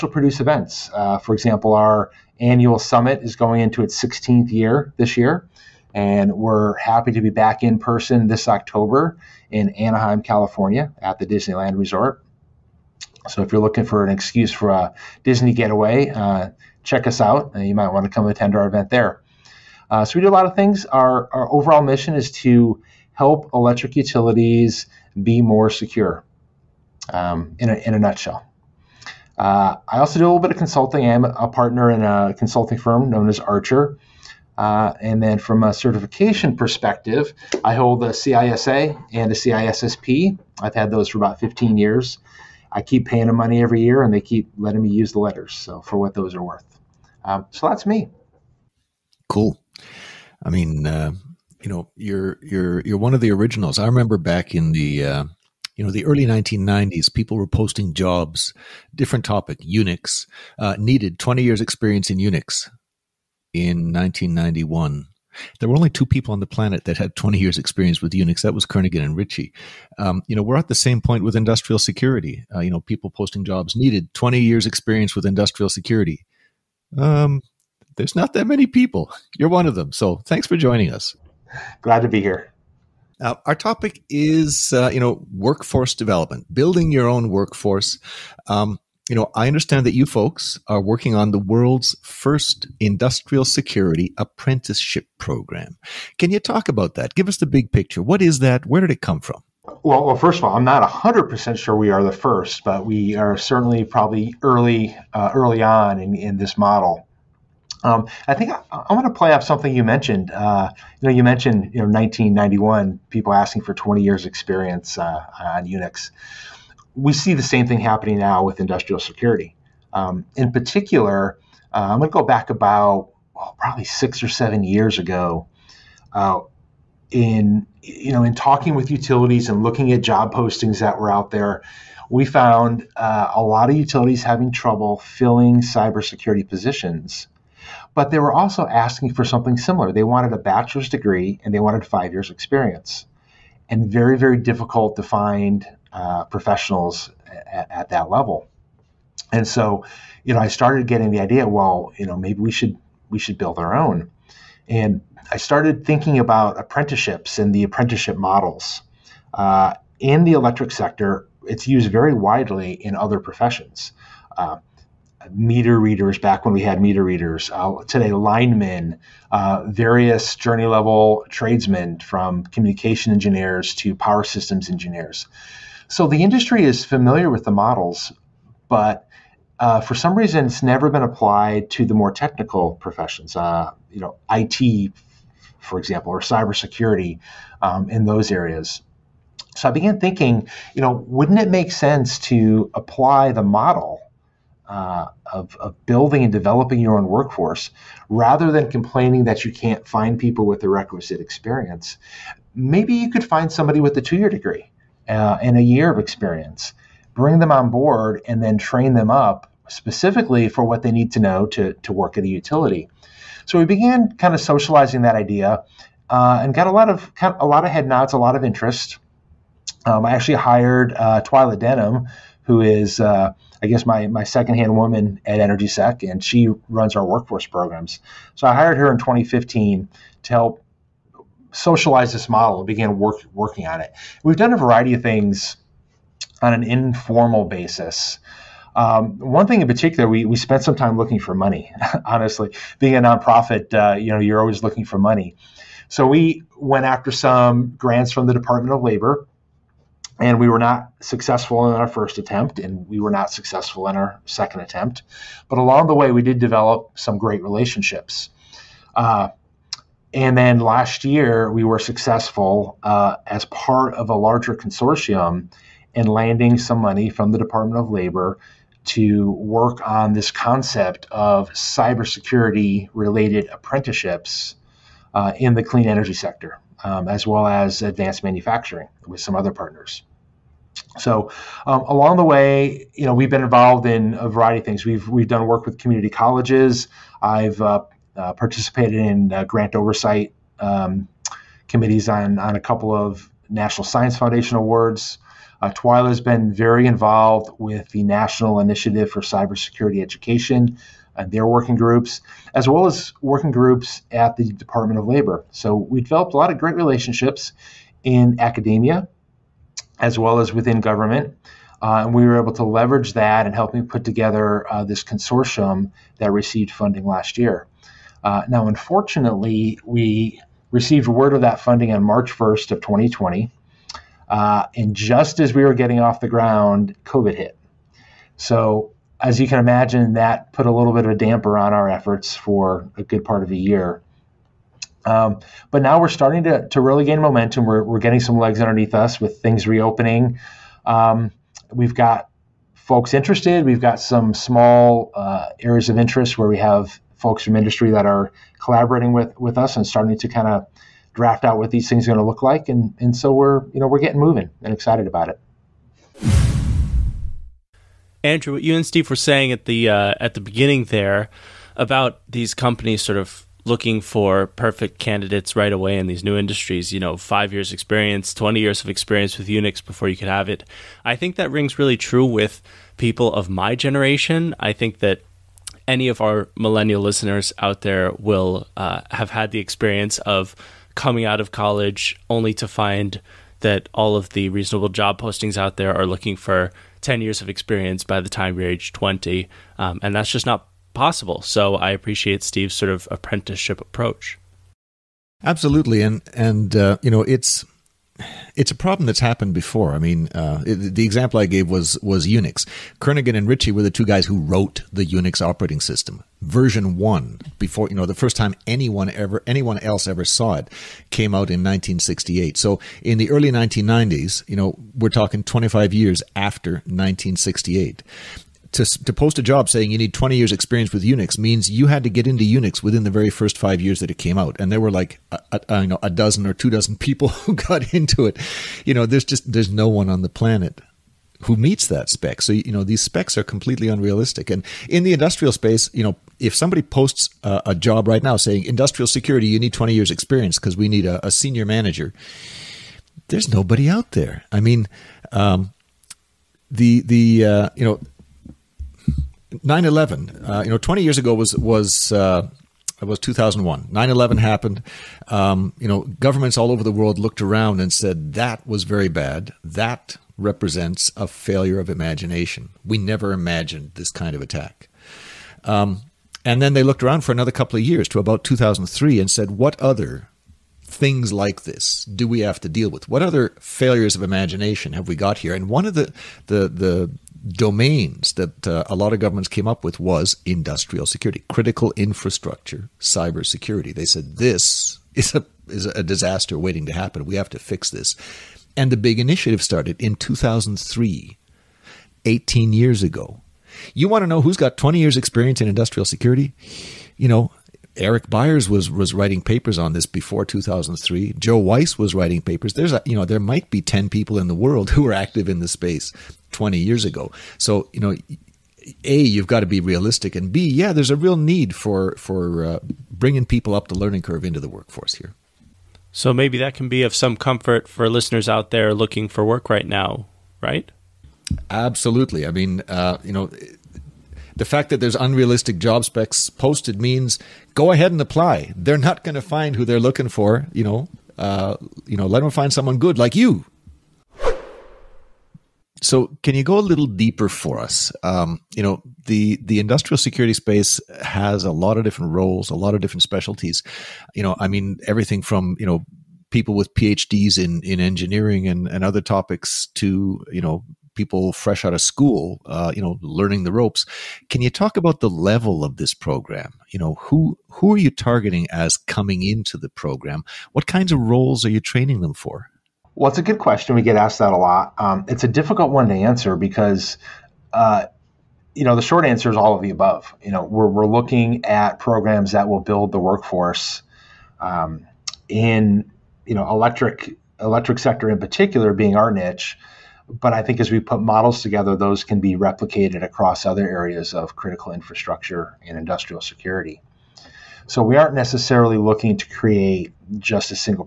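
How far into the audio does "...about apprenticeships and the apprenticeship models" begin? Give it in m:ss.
2:36.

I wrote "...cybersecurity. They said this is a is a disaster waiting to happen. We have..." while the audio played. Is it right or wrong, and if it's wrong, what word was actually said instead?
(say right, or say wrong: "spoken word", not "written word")
right.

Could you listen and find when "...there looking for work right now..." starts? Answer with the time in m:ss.
8:38.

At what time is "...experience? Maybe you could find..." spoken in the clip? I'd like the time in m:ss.
3:21.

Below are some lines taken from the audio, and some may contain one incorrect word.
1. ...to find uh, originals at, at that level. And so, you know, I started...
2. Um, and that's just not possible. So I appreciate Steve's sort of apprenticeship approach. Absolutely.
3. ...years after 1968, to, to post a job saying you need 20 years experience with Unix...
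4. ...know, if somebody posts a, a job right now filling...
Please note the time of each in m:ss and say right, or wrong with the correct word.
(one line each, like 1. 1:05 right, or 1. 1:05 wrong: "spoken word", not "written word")
1. 2:24 wrong: "professionals", not "originals"
2. 6:29 right
3. 6:55 right
4. 7:16 wrong: "saying", not "filling".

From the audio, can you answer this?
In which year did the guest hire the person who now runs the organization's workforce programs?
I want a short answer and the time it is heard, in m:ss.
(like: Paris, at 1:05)
2015, at 3:48.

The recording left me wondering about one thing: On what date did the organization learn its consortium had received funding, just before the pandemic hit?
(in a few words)
March 1, 2020.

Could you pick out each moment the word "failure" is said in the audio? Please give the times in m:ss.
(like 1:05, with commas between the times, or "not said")
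7:41, 7:53.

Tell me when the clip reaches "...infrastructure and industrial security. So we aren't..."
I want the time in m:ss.
9:44.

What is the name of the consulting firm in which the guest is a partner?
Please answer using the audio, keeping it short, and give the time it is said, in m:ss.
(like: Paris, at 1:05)
Archer, at 0:33.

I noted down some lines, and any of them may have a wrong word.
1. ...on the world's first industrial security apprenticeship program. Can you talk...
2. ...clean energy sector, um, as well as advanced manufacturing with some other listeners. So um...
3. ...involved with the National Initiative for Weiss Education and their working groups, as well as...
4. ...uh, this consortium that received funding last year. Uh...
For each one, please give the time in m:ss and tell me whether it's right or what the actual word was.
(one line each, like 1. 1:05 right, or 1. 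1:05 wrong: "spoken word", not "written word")
1. 1:31 right
2. 4:35 wrong: "partners", not "listeners"
3. 4:56 wrong: "Cybersecurity", not "Weiss"
4. 5:14 right.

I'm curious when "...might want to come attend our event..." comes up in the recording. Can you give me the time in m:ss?
0:17.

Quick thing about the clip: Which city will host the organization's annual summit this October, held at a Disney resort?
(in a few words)
Anaheim.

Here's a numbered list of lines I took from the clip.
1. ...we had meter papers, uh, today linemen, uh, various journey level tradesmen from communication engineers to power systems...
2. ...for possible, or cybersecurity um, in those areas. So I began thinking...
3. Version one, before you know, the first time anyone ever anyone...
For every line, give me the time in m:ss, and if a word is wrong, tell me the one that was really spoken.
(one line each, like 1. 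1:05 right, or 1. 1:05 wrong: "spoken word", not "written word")
1. 2:46 wrong: "readers", not "papers"
2. 3:05 wrong: "example", not "possible"
3. 6:46 right.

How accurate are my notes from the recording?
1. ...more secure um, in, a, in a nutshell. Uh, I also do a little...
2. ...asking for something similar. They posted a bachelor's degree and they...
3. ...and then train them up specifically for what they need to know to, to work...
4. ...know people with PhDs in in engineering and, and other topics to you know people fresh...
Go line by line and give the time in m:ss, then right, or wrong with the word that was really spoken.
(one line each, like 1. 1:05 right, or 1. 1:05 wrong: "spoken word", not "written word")
1. 0:25 right
2. 2:18 wrong: "wanted", not "posted"
3. 3:28 right
4. 9:05 right.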